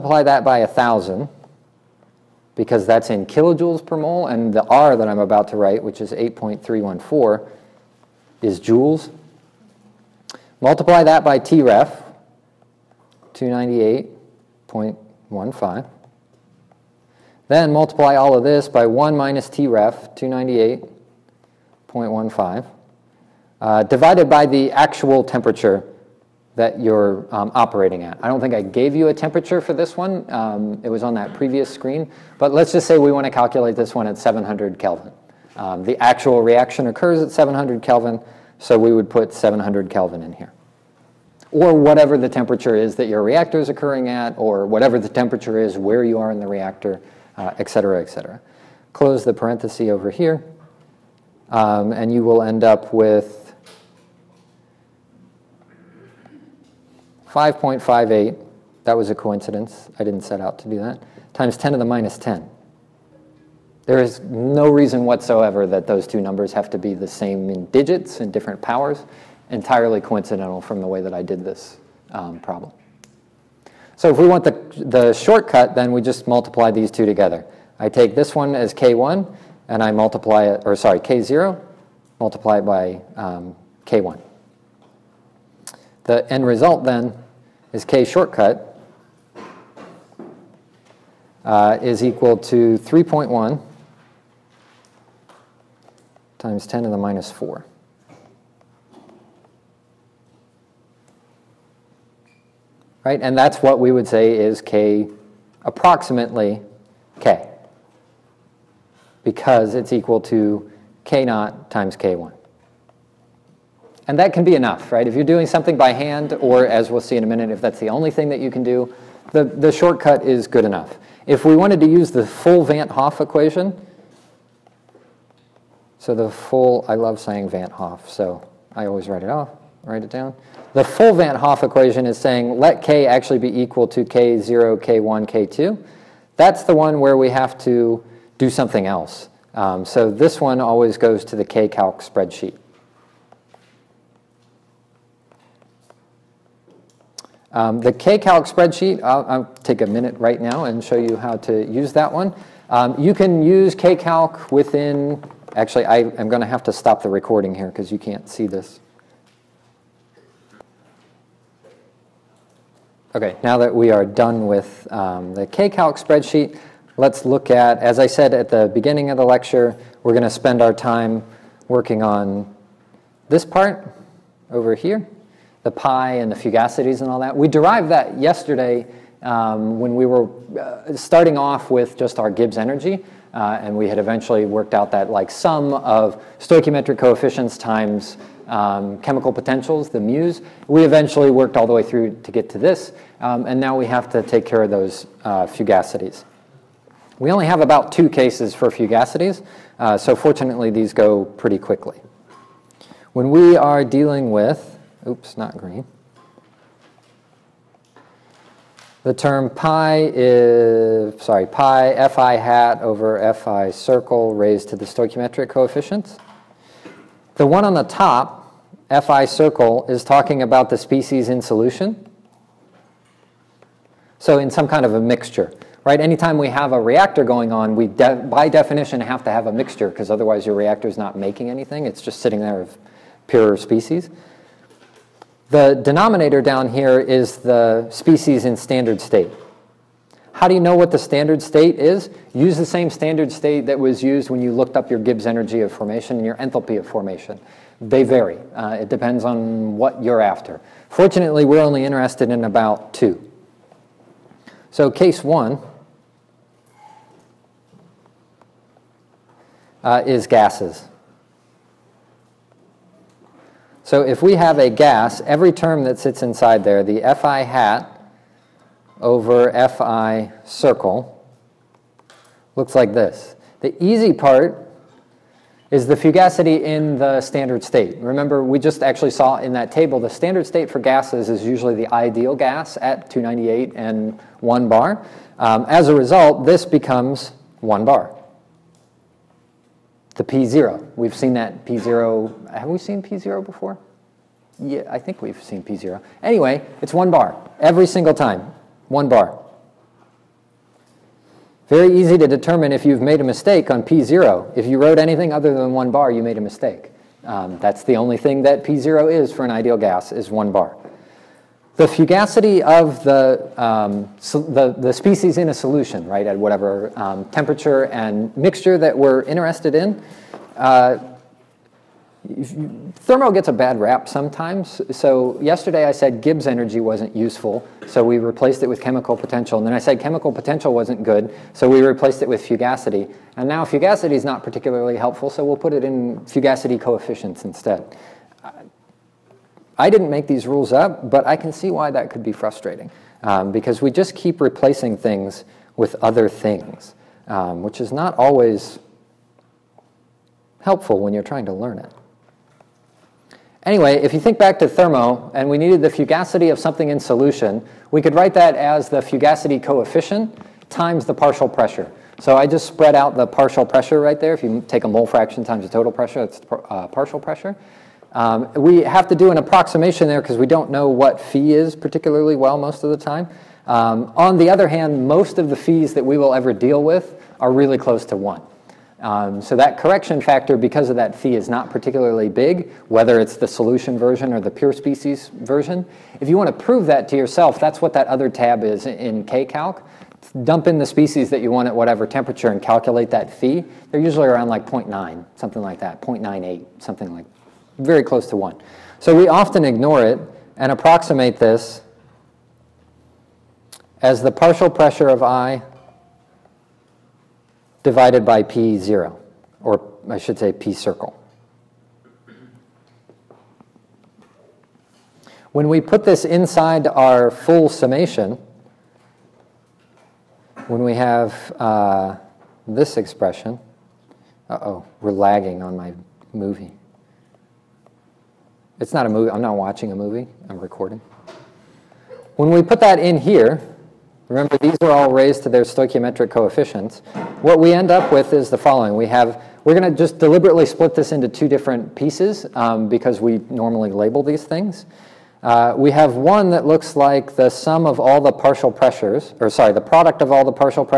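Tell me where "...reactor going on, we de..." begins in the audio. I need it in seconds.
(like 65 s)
226 s.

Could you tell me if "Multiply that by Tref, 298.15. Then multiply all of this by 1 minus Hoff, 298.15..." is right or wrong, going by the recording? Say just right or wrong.
wrong.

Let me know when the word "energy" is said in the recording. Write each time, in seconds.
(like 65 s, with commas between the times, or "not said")
182 s, 245 s, 326 s.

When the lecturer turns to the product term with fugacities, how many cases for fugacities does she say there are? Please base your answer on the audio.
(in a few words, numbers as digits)
2.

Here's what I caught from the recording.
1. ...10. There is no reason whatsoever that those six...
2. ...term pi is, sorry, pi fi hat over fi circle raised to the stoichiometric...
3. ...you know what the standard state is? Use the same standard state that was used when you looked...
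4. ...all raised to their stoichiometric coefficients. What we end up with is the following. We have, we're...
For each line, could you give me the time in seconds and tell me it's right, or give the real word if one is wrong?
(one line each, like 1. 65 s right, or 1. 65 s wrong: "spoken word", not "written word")
1. 62 s wrong: "two", not "six"
2. 209 s right
3. 240 s right
4. 434 s right.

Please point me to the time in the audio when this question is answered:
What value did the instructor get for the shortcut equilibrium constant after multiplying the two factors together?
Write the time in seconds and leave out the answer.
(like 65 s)
92 s.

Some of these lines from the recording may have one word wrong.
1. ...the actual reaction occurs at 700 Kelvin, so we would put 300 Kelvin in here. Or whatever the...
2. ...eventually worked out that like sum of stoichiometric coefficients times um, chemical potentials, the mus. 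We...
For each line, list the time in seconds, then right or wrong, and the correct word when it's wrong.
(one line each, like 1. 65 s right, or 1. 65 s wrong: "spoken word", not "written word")
1. 35 s wrong: "700", not "300"
2. 183 s right.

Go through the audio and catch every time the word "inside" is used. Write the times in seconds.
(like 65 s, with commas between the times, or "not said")
266 s, 416 s.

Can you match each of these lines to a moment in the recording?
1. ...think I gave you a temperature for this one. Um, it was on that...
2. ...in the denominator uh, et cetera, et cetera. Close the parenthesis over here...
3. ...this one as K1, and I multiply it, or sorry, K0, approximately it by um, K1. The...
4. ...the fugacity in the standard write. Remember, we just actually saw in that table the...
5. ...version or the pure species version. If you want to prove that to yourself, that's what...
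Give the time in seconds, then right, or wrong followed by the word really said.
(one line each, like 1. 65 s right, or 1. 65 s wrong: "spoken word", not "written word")
1. 28 s right
2. 46 s wrong: "reactor", not "denominator"
3. 78 s wrong: "multiply", not "approximately"
4. 275 s wrong: "state", not "write"
5. 383 s right.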